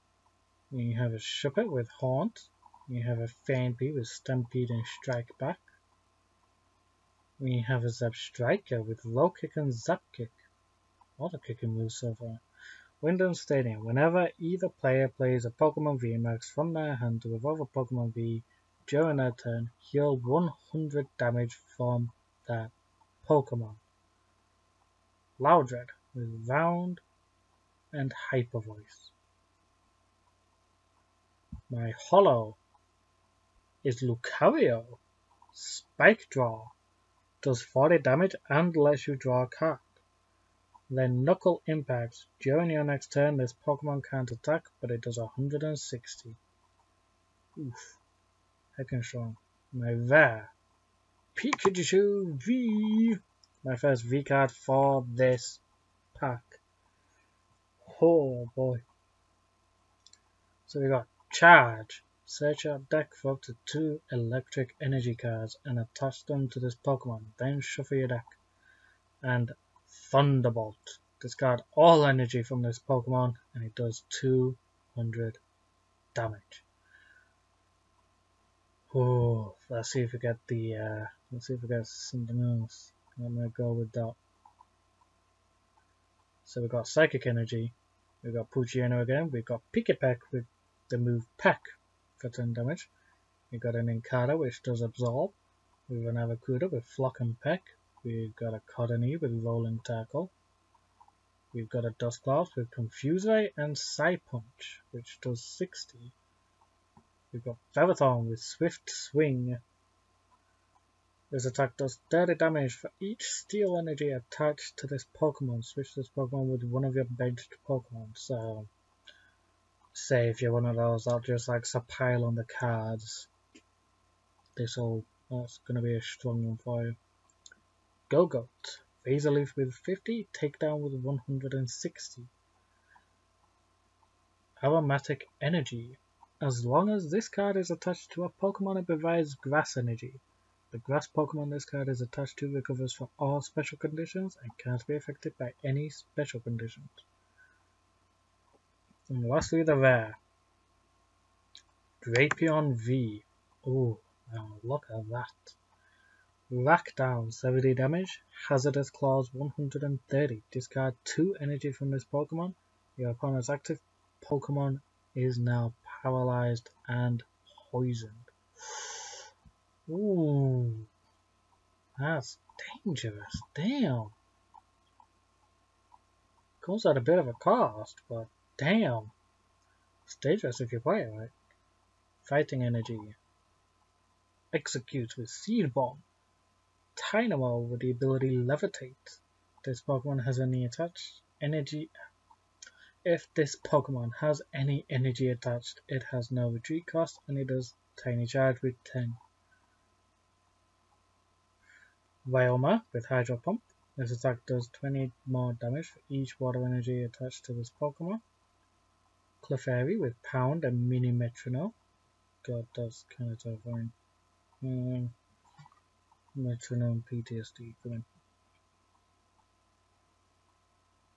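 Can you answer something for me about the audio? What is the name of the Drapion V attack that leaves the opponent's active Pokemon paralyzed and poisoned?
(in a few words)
Hazardous Claws.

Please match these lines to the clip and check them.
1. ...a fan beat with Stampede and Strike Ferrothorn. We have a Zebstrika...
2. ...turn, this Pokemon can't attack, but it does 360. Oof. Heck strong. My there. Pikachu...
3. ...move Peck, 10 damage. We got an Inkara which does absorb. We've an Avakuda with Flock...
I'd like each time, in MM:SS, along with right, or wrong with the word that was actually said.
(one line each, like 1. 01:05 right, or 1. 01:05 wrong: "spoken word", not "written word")
1. 00:03 wrong: "Back", not "Ferrothorn"
2. 00:43 wrong: "160", not "360"
3. 01:30 right.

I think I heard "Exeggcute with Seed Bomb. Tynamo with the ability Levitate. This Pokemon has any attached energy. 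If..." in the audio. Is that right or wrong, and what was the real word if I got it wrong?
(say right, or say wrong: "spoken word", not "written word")
right.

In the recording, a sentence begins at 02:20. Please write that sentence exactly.
The grass Pokemon this card is attached to recovers from all special conditions and can't be affected by any special conditions.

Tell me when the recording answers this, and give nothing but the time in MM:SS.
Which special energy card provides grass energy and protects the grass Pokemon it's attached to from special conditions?
02:14.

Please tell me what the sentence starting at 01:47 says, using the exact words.
We've got Ferrothorn with Swift Swing.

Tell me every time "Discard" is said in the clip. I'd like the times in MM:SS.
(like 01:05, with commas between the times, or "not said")
01:11, 02:40.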